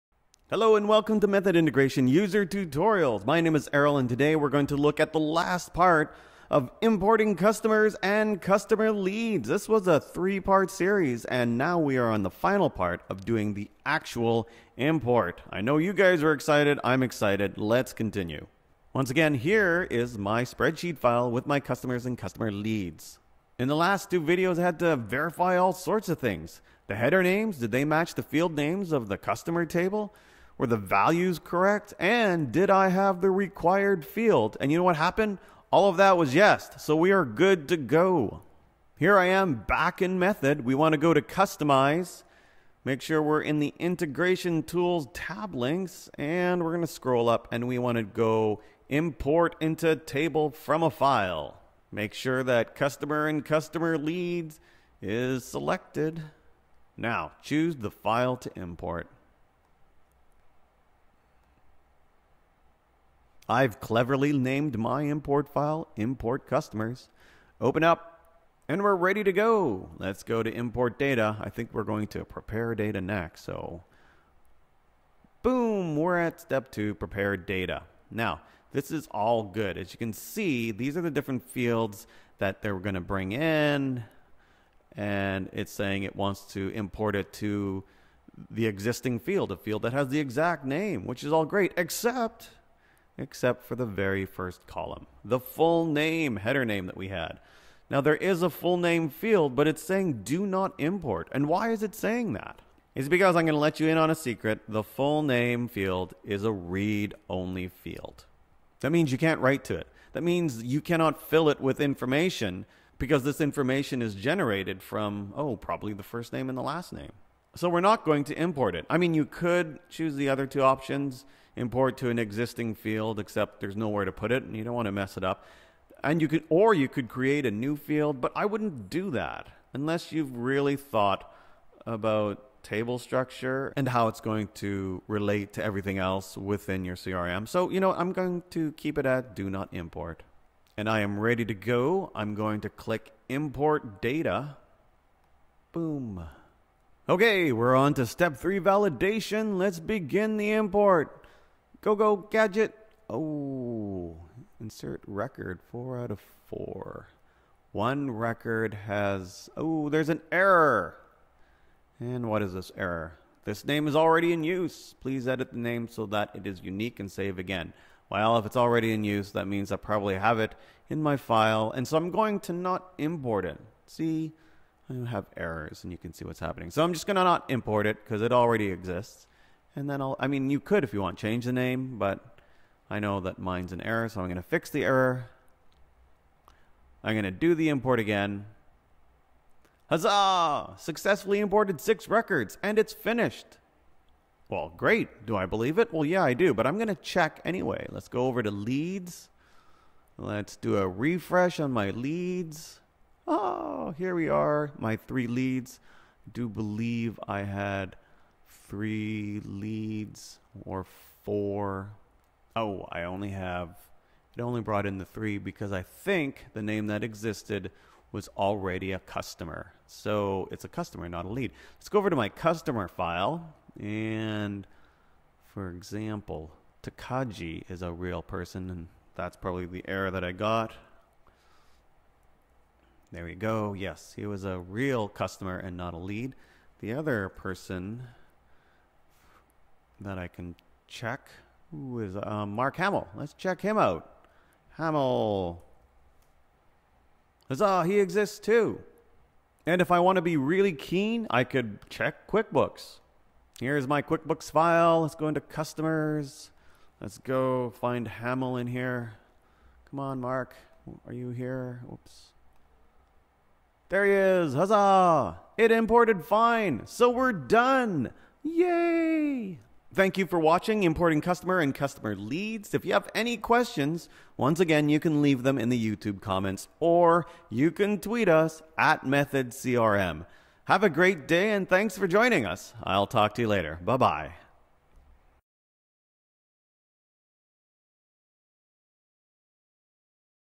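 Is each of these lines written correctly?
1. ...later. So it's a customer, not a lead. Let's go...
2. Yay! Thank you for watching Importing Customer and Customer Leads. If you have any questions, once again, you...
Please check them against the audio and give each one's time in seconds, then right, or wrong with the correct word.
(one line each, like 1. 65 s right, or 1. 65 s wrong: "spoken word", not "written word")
1. 218 s wrong: "customer", not "later"
2. 268 s right.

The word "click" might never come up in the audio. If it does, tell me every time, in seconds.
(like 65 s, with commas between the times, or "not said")
142 s.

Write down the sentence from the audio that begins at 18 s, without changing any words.
Once again, here is my spreadsheet file with my customers and customer leads.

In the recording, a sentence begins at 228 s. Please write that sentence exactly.
And that's probably the error that I got.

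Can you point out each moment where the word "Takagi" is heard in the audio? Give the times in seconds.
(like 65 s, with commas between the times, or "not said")
226 s.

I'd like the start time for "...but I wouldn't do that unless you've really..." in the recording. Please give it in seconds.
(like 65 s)
128 s.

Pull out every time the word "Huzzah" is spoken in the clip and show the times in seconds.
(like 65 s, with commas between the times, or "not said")
189 s, 247 s, 264 s.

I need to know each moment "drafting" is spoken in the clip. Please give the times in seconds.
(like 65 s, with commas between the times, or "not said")
not said.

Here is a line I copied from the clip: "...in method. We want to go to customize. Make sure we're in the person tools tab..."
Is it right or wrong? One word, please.
wrong.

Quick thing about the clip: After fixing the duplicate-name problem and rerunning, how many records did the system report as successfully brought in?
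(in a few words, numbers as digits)
6.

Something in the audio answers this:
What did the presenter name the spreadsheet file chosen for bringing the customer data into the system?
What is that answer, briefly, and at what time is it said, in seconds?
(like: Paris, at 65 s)
import customers, at 65 s.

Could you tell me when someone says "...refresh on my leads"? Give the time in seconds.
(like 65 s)
200 s.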